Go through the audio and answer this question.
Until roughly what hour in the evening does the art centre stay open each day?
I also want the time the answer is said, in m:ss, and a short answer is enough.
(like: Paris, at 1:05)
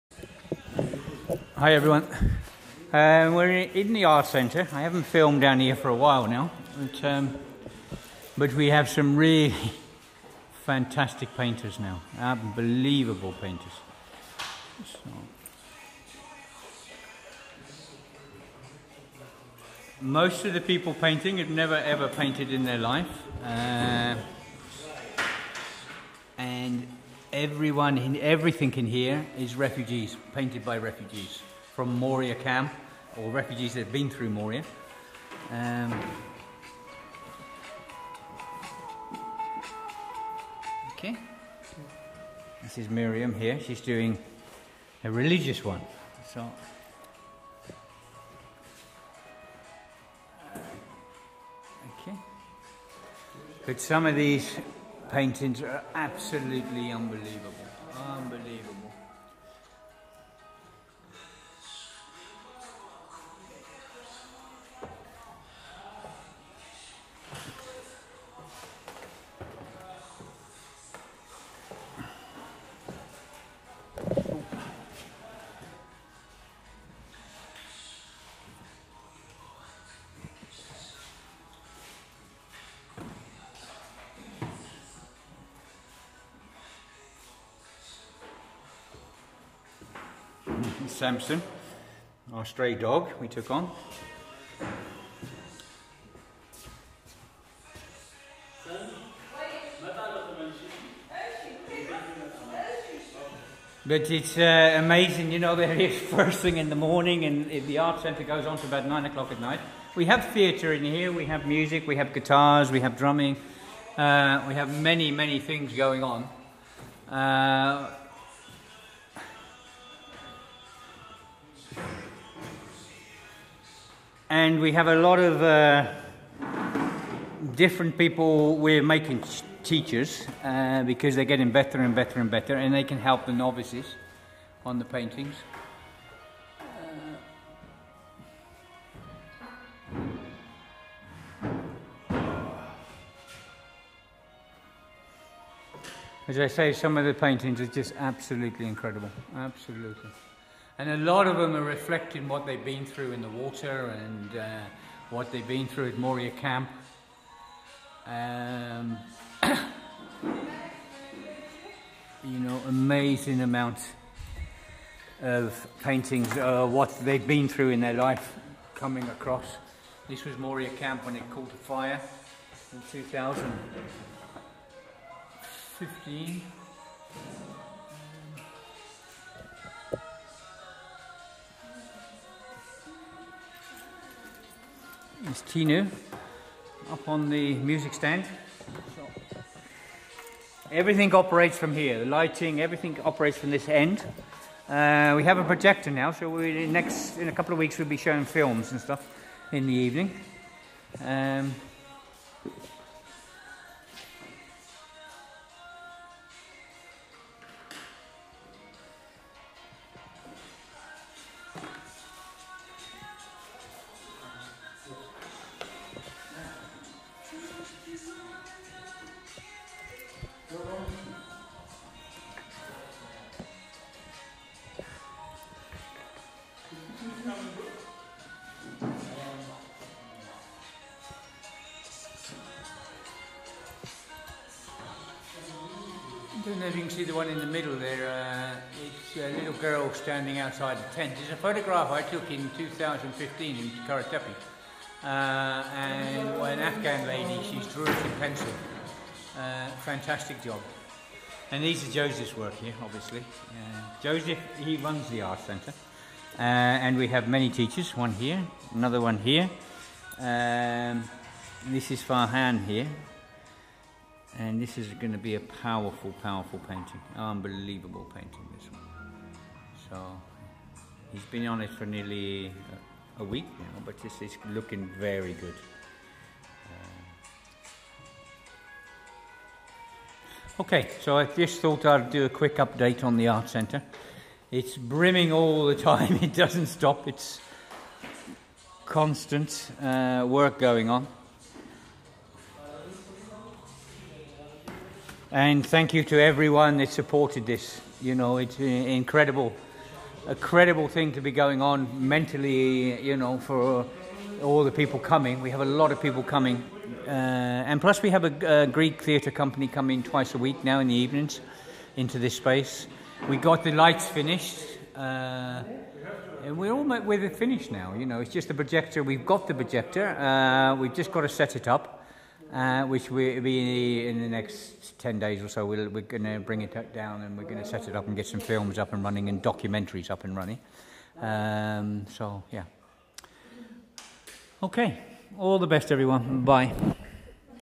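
9 o'clock, at 1:48.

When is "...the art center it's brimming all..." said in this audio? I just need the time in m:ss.
4:43.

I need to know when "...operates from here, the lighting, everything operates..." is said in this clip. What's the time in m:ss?
3:11.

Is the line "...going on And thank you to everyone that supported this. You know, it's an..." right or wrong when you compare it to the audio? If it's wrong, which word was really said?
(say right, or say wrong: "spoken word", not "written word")
right.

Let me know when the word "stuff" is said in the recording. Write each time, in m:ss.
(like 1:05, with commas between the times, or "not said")
3:18.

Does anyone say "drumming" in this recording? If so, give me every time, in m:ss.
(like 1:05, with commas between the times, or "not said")
1:52.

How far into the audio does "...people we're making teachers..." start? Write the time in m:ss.
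2:07.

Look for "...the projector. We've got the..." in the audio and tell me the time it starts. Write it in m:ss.
5:18.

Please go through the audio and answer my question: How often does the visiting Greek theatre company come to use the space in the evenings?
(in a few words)
Twice a week.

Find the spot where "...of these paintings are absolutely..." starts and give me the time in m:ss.
0:54.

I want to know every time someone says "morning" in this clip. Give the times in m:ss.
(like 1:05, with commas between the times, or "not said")
1:46.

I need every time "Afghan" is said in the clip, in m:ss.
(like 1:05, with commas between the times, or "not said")
4:06.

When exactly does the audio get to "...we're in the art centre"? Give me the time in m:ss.
0:03.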